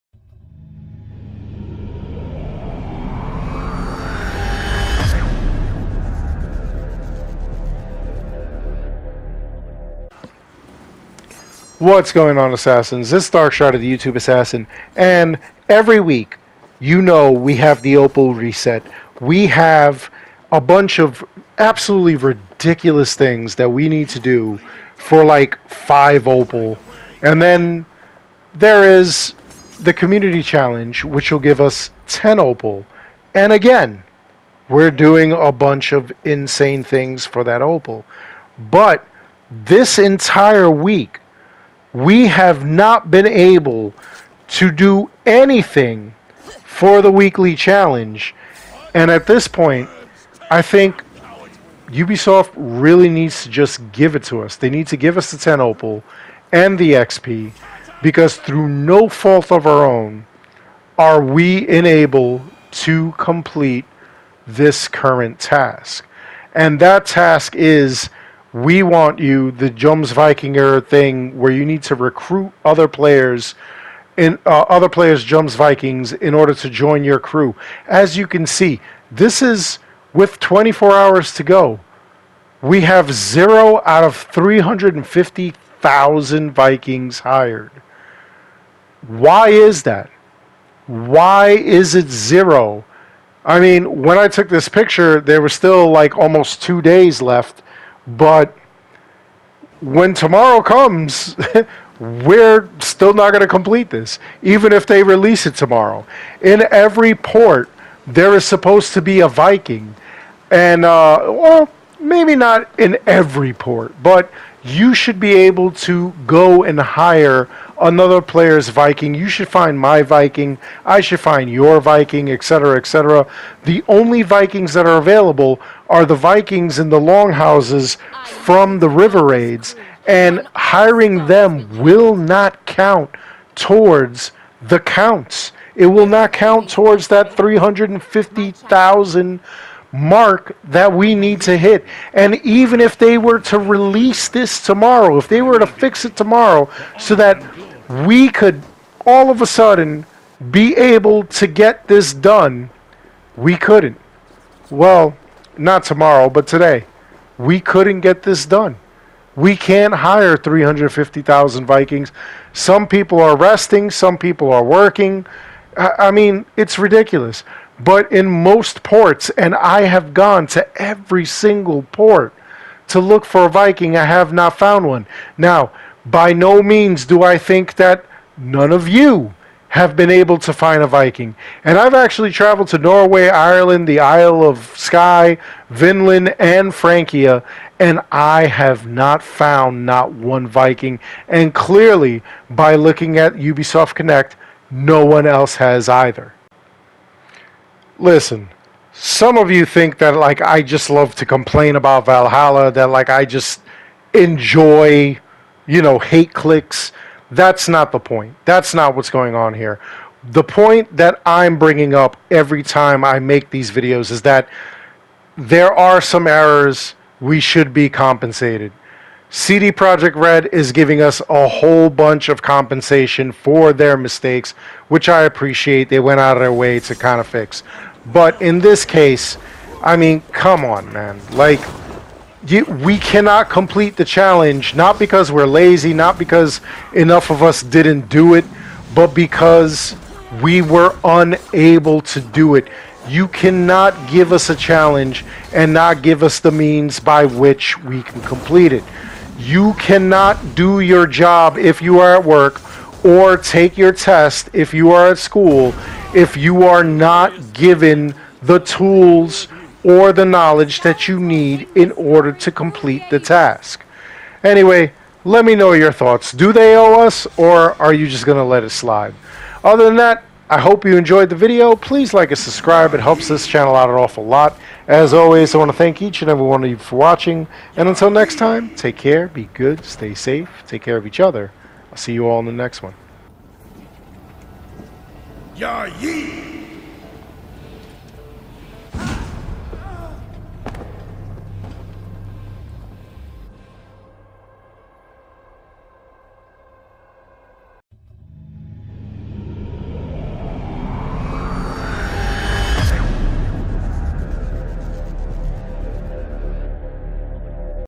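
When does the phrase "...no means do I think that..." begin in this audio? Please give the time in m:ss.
2:56.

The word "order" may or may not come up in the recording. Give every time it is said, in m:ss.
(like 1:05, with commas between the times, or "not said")
1:16, 4:21.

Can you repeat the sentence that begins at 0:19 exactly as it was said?
We have a bunch of absolutely ridiculous things that we need to do for like five Opal.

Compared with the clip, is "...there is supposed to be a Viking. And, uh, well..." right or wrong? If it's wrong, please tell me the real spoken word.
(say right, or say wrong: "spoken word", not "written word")
right.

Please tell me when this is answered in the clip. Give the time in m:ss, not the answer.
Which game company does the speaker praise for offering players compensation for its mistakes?
3:39.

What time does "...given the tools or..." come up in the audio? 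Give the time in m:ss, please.
4:17.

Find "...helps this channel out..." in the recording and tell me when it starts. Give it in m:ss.
4:32.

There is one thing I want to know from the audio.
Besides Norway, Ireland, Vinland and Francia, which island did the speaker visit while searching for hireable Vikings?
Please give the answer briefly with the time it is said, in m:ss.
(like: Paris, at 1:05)
Isle of Skye, at 3:04.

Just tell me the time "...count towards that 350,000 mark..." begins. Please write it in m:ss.
2:16.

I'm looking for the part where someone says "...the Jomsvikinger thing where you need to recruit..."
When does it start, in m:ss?
1:09.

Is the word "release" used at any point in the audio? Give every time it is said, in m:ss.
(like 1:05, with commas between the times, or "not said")
1:45, 2:23.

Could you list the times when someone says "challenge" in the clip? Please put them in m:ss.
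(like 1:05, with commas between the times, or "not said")
0:30, 0:47, 3:54, 4:04.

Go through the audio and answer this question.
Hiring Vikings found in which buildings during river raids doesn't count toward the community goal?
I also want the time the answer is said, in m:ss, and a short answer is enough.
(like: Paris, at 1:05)
longhouses, at 2:06.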